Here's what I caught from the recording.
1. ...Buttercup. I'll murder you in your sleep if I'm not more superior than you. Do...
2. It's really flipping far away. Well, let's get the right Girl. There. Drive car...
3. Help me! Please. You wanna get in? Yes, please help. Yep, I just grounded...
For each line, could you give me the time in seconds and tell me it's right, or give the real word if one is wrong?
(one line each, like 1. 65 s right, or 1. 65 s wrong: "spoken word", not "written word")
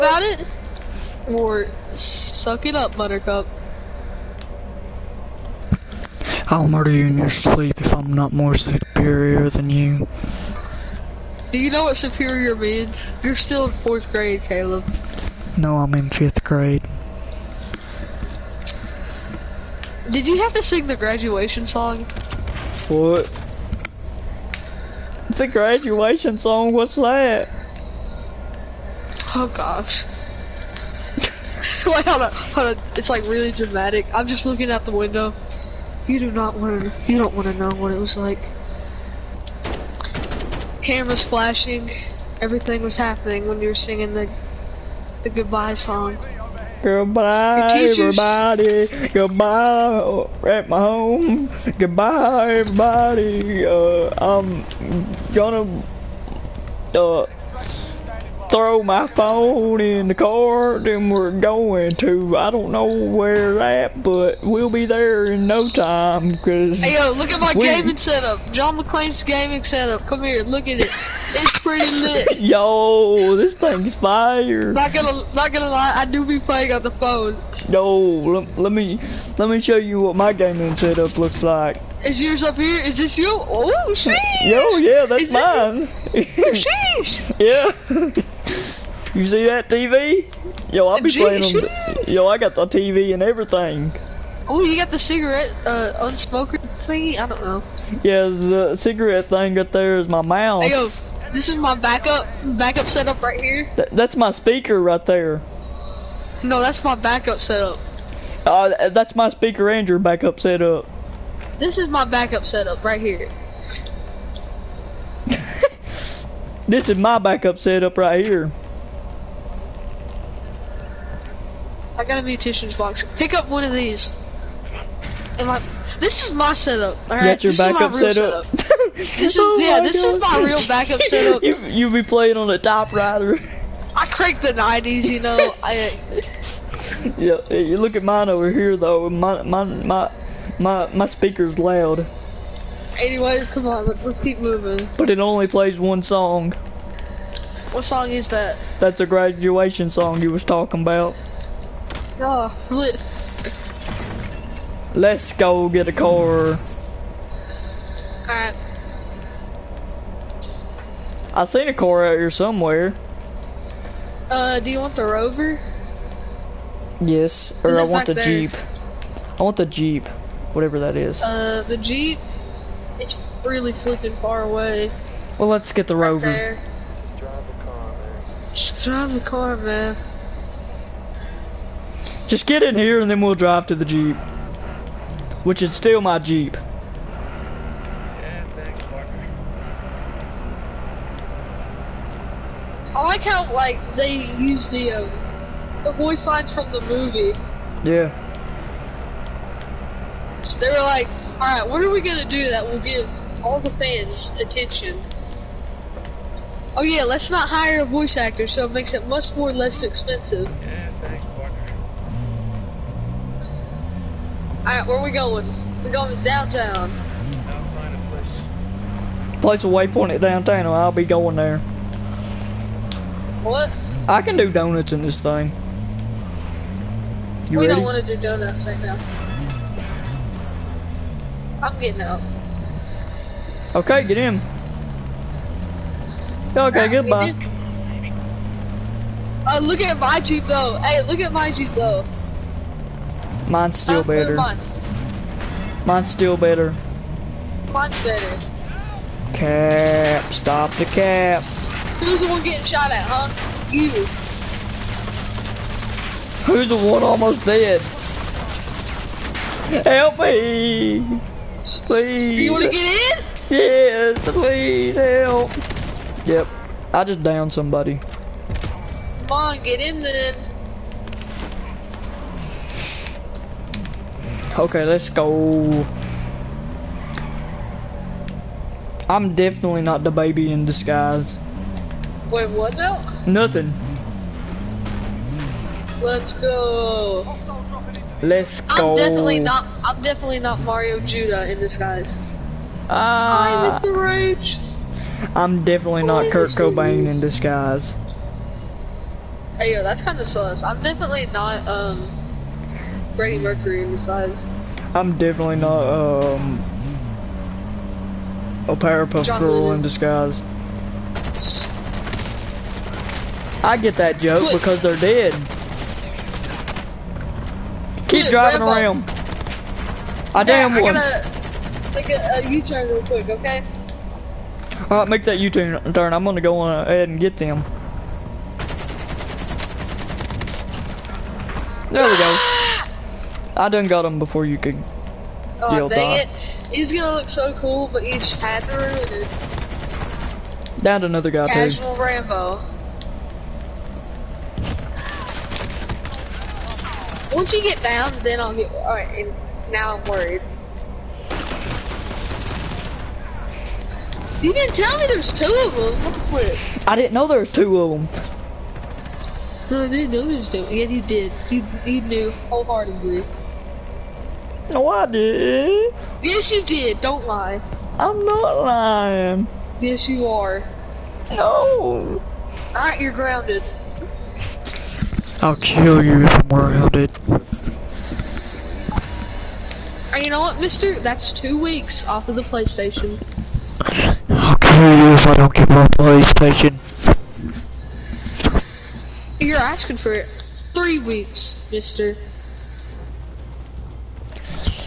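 1. 2 s right
2. 172 s wrong: "Rover", not "Girl"
3. 259 s wrong: "downed", not "grounded".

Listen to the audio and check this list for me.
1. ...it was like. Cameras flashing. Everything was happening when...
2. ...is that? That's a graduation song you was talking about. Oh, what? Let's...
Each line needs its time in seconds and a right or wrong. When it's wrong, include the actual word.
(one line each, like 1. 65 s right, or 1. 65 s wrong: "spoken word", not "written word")
1. 37 s right
2. 148 s right.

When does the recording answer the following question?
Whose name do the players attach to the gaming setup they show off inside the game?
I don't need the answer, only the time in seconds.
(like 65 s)
68 s.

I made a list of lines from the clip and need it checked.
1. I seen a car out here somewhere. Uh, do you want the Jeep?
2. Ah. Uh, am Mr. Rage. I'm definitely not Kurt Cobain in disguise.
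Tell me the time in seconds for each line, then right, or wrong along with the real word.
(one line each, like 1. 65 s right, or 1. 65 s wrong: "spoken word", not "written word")
1. 161 s wrong: "Rover", not "Jeep"
2. 292 s right.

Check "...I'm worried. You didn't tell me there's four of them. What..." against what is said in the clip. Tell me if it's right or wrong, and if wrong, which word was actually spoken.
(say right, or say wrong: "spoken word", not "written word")
wrong: "two", not "four".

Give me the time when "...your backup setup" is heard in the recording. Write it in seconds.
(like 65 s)
109 s.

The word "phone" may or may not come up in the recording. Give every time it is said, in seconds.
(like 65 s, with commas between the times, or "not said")
59 s, 76 s.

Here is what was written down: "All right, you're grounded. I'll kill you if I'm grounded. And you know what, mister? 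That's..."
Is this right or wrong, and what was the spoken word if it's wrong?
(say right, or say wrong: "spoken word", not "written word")
right.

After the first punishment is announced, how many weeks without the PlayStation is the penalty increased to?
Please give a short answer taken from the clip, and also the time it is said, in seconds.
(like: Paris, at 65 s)
3 weeks, at 390 s.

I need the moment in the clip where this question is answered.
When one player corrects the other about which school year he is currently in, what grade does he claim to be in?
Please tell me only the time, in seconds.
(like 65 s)
16 s.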